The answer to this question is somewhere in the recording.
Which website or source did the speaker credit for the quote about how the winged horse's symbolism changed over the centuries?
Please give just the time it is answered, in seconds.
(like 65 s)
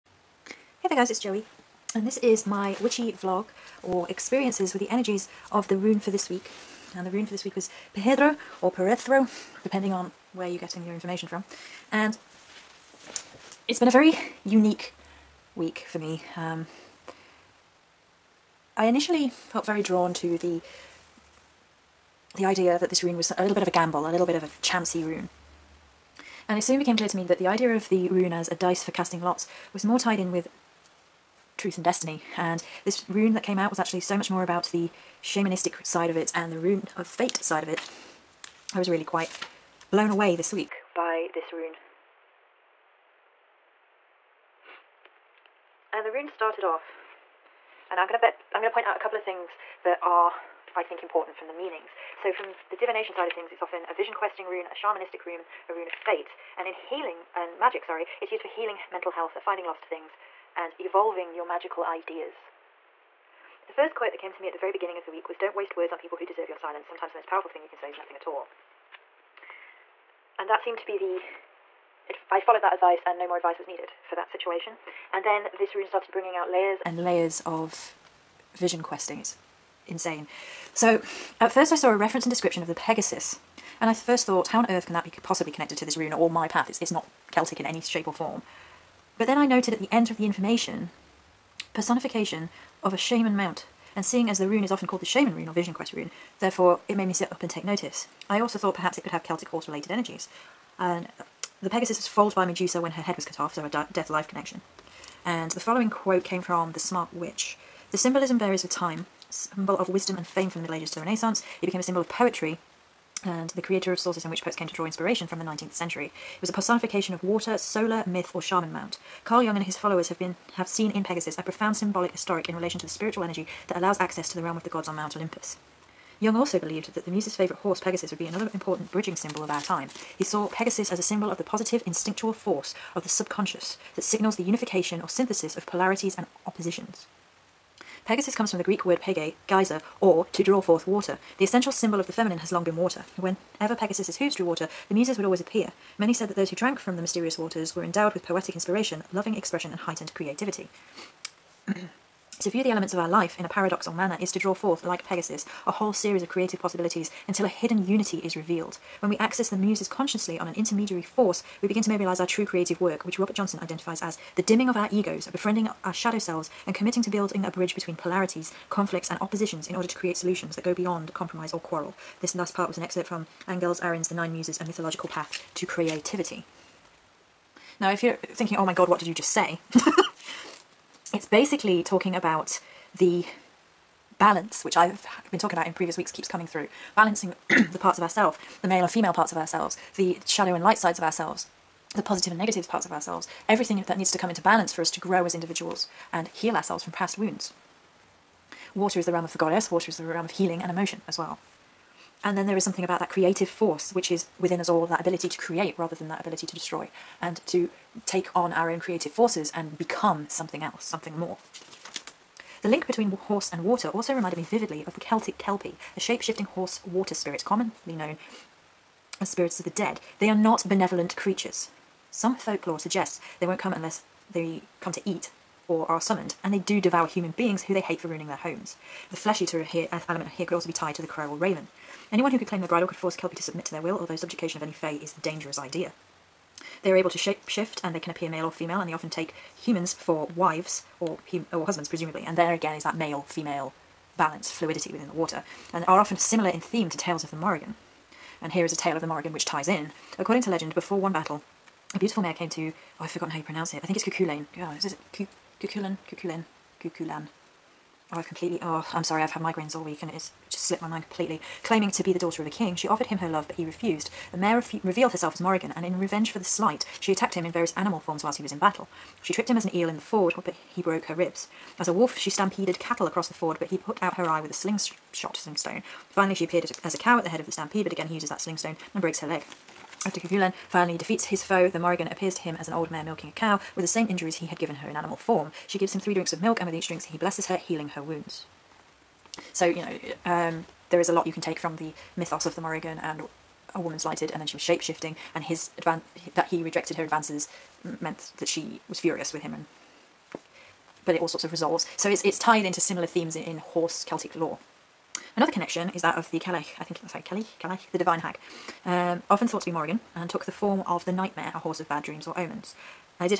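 106 s.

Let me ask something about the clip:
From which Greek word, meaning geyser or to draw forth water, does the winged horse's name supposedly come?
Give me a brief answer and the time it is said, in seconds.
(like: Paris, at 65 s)
pege, at 139 s.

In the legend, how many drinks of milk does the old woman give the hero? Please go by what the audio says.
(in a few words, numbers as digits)
3.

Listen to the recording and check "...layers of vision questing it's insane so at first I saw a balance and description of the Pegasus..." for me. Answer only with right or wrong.
wrong.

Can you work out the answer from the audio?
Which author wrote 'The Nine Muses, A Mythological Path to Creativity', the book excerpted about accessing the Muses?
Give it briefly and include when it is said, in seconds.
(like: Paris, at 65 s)
Angeles Arrien, at 173 s.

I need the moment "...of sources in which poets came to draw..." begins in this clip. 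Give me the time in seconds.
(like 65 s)
113 s.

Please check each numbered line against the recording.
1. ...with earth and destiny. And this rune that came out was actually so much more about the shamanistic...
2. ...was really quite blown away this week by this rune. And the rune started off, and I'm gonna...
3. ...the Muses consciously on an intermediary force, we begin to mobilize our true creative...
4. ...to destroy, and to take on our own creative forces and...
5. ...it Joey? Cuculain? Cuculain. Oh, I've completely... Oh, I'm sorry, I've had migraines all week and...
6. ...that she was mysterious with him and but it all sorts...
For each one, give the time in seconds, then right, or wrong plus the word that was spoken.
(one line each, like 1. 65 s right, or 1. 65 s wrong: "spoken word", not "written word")
1. 30 s wrong: "truth", not "earth"
2. 38 s right
3. 159 s right
4. 206 s right
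5. 254 s wrong: "Cuculain", not "Joey"
6. 298 s wrong: "furious", not "mysterious".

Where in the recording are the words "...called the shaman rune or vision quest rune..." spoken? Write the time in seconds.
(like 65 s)
94 s.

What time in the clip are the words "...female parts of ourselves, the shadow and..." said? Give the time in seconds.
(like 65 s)
188 s.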